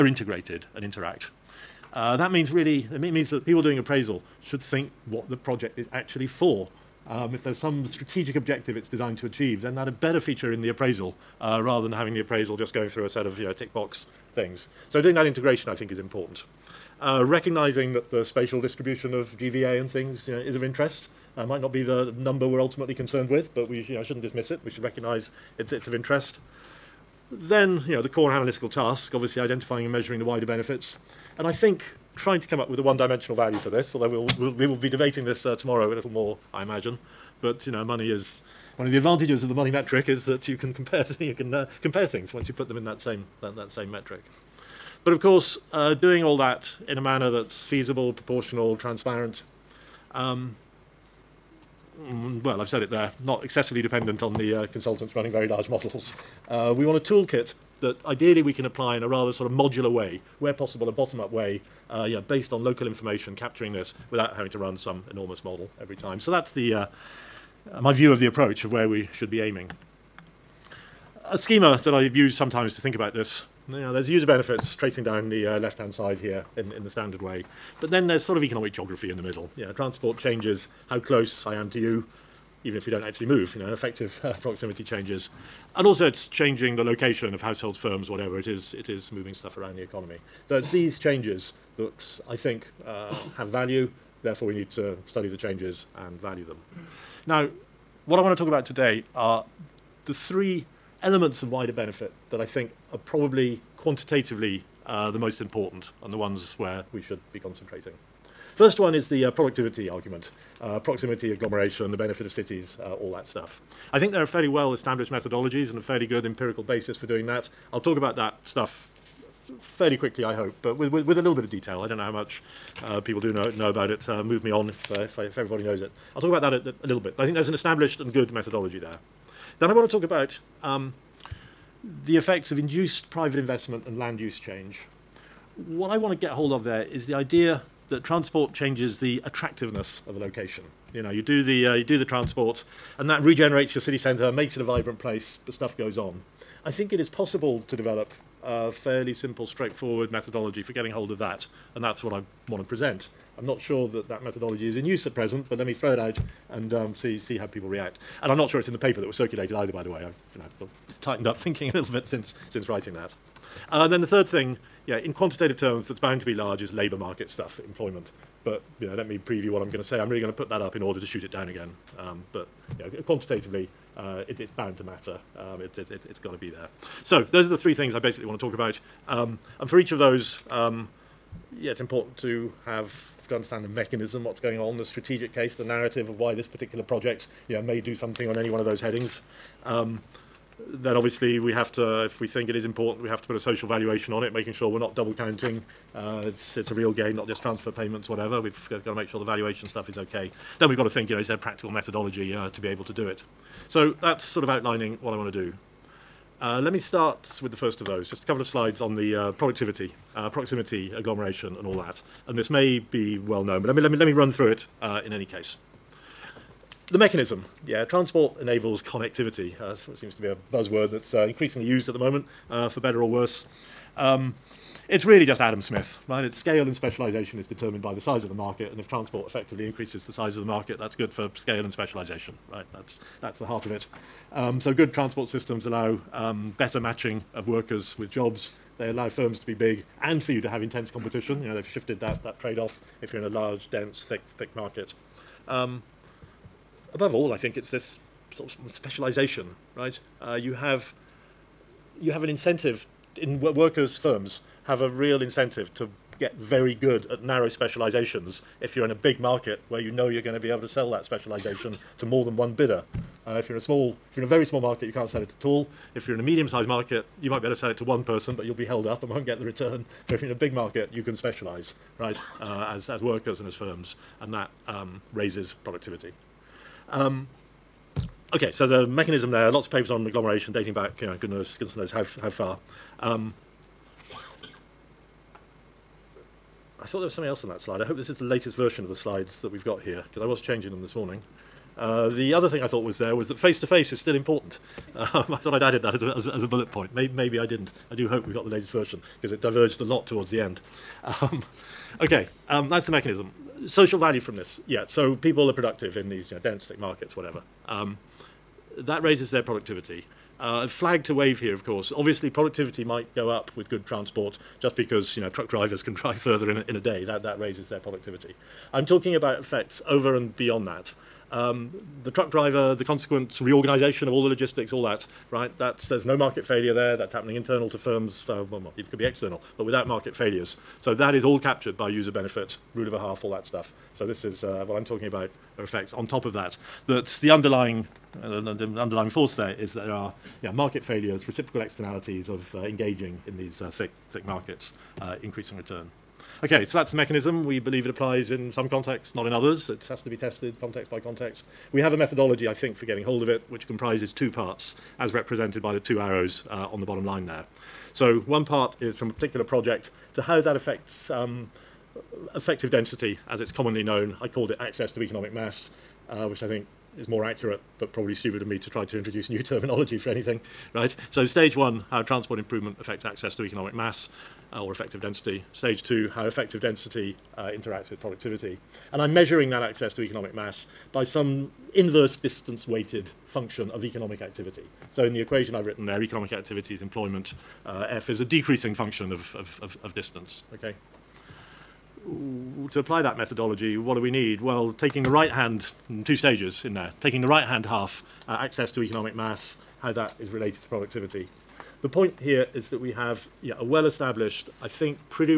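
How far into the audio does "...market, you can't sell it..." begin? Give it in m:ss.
4:24.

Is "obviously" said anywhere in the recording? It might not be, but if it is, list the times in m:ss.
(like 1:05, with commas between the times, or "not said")
0:29, 3:10, 5:11.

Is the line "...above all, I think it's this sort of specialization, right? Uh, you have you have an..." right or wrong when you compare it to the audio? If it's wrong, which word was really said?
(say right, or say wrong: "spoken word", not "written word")
right.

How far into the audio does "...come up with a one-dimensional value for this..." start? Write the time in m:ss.
0:32.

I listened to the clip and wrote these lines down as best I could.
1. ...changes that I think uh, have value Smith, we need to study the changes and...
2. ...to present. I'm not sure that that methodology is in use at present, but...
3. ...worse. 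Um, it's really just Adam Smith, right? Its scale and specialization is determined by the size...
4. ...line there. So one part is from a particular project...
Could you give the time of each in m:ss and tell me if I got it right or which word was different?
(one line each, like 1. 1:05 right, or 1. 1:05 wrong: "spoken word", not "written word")
1. 1:30 wrong: "Therefore", not "Smith"
2. 2:32 right
3. 3:43 right
4. 5:57 right.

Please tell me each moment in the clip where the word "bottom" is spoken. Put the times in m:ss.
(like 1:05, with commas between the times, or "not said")
1:00, 5:56.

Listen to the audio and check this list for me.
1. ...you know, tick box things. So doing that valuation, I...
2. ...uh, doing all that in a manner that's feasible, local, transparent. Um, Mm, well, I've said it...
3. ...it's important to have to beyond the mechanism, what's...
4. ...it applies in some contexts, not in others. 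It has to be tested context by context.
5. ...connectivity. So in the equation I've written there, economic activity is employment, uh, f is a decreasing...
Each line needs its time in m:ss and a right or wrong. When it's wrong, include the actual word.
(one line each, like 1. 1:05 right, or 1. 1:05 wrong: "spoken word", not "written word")
1. 0:13 wrong: "integration", not "valuation"
2. 0:45 wrong: "proportional", not "local"
3. 3:01 wrong: "understand", not "beyond"
4. 5:47 right
5. 6:24 wrong: "activity", not "connectivity".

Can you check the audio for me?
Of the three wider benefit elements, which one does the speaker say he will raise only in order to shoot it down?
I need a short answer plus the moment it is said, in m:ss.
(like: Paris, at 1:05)
Labour market stuff, at 2:46.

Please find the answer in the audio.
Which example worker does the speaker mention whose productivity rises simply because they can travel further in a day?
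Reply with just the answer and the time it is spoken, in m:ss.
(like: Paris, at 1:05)
Truck drivers, at 5:15.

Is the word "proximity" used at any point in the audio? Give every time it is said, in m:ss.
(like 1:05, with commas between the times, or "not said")
1:24, 1:50, 3:30.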